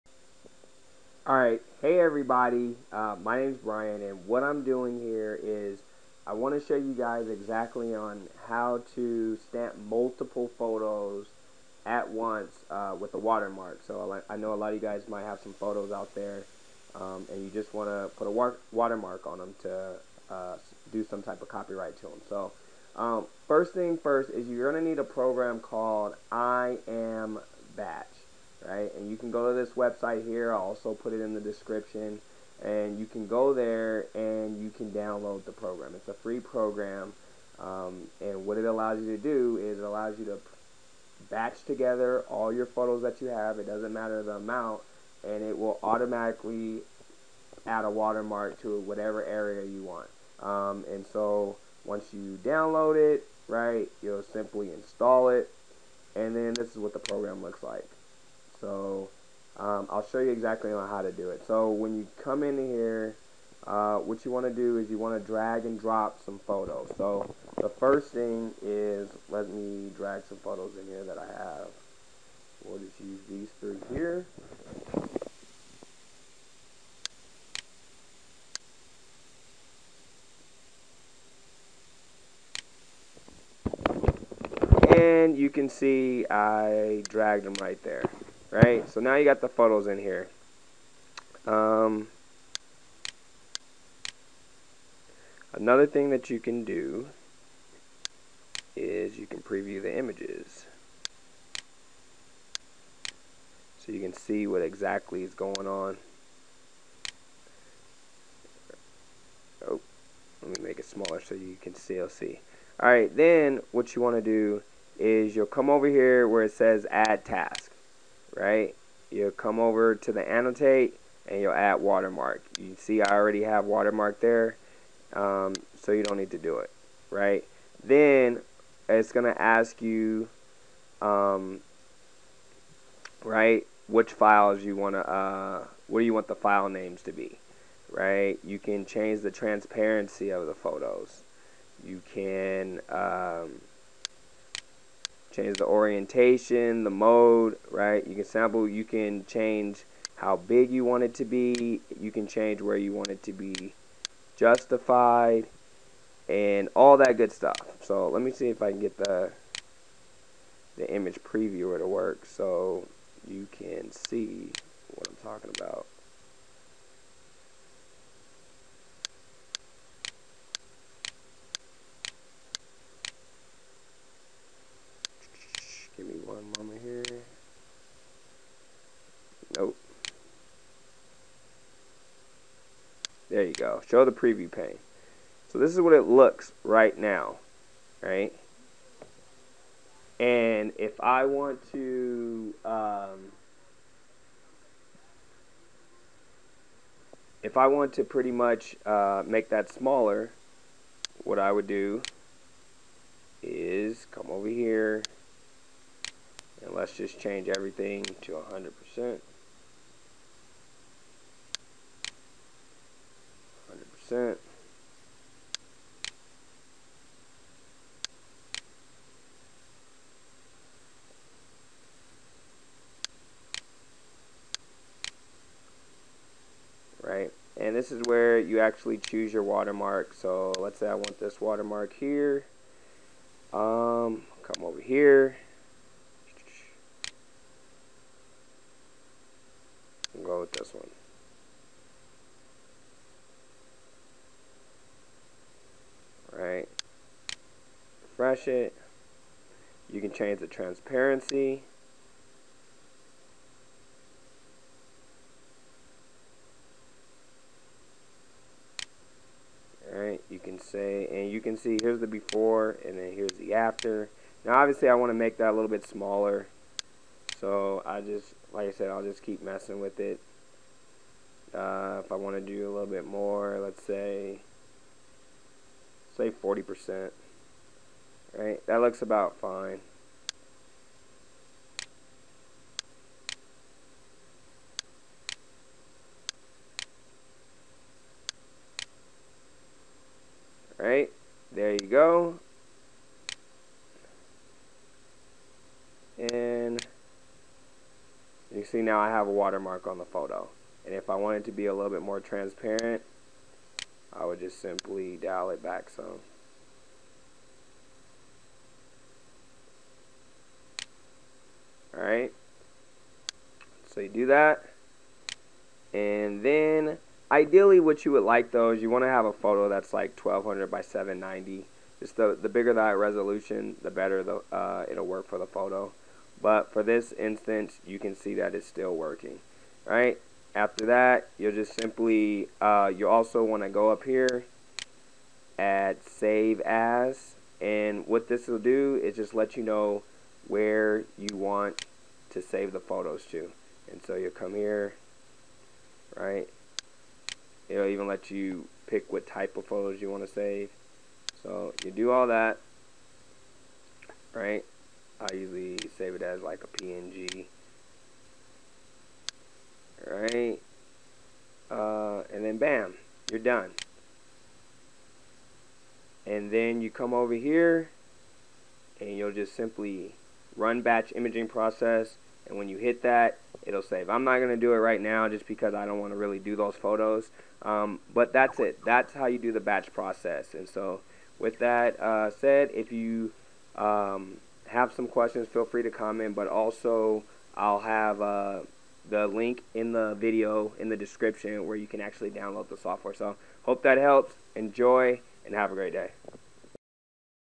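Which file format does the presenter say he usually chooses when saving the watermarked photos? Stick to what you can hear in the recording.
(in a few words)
PNG.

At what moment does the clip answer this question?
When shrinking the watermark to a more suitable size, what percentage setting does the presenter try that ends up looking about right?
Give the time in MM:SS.
04:36.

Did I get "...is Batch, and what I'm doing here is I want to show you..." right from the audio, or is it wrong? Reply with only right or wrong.
wrong.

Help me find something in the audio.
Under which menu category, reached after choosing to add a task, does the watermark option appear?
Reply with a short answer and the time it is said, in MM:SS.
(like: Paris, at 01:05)
annotate, at 02:00.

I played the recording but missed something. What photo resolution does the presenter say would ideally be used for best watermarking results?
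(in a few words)
1200 by 790.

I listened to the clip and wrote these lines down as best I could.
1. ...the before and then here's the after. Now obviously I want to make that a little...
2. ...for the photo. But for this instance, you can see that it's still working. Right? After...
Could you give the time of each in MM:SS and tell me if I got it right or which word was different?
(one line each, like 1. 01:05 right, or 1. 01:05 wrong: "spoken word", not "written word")
1. 04:21 right
2. 05:25 right.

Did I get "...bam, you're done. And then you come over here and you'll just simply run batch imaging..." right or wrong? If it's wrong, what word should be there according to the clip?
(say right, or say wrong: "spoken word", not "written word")
right.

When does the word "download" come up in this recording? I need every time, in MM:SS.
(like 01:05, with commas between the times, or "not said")
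00:34, 00:52, 06:32.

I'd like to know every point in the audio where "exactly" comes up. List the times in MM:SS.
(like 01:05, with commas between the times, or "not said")
00:07, 01:00, 01:44.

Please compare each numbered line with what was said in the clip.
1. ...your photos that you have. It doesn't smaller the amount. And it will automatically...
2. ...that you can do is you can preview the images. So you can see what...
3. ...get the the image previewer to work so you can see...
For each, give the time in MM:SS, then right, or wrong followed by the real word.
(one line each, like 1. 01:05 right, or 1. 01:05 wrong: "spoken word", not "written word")
1. 00:42 wrong: "matter", not "smaller"
2. 01:36 right
3. 02:38 right.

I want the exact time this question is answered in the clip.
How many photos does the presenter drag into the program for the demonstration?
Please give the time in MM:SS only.
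01:13.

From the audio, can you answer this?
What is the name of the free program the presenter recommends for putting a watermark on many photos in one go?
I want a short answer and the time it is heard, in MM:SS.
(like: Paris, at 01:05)
I Am Batch, at 00:26.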